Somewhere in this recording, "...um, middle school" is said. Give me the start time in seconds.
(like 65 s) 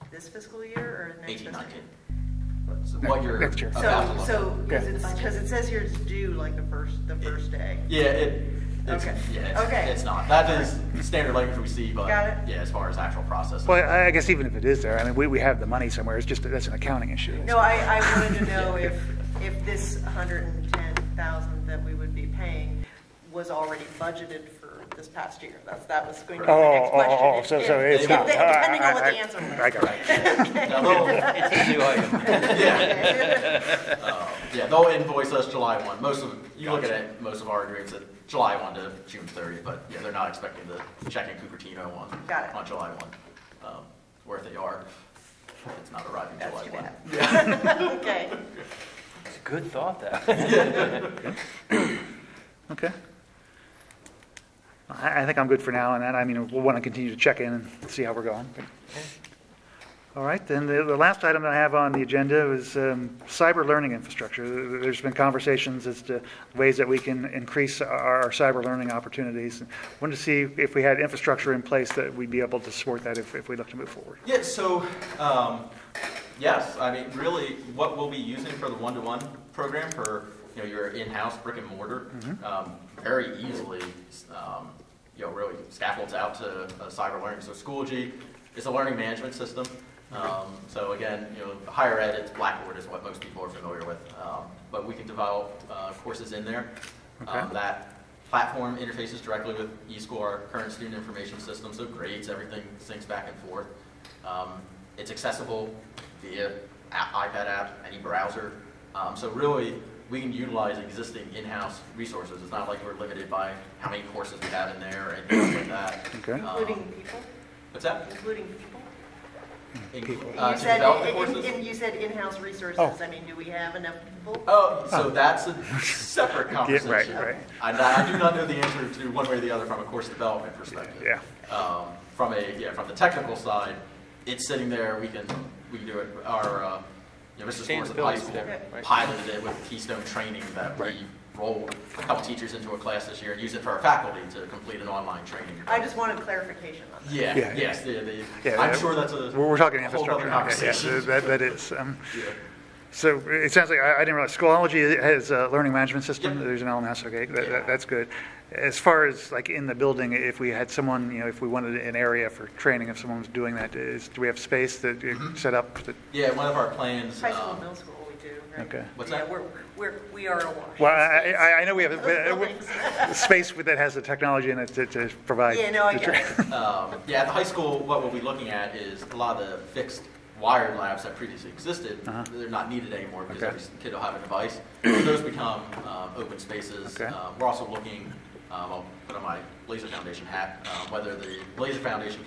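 167 s.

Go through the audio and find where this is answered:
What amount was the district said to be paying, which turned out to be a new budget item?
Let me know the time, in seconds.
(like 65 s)
20 s.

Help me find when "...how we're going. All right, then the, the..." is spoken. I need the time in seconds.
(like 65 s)
58 s.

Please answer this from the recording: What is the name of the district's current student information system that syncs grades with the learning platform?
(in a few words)
eSchool.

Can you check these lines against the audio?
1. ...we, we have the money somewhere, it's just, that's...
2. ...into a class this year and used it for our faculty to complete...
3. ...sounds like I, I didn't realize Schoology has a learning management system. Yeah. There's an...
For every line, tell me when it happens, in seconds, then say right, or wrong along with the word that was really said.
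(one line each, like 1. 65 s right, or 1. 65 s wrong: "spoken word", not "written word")
1. 15 s right
2. 142 s right
3. 153 s right.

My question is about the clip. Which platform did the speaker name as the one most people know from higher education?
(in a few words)
Blackboard.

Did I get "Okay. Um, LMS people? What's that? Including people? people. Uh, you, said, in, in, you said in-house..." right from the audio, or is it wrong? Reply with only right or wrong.
wrong.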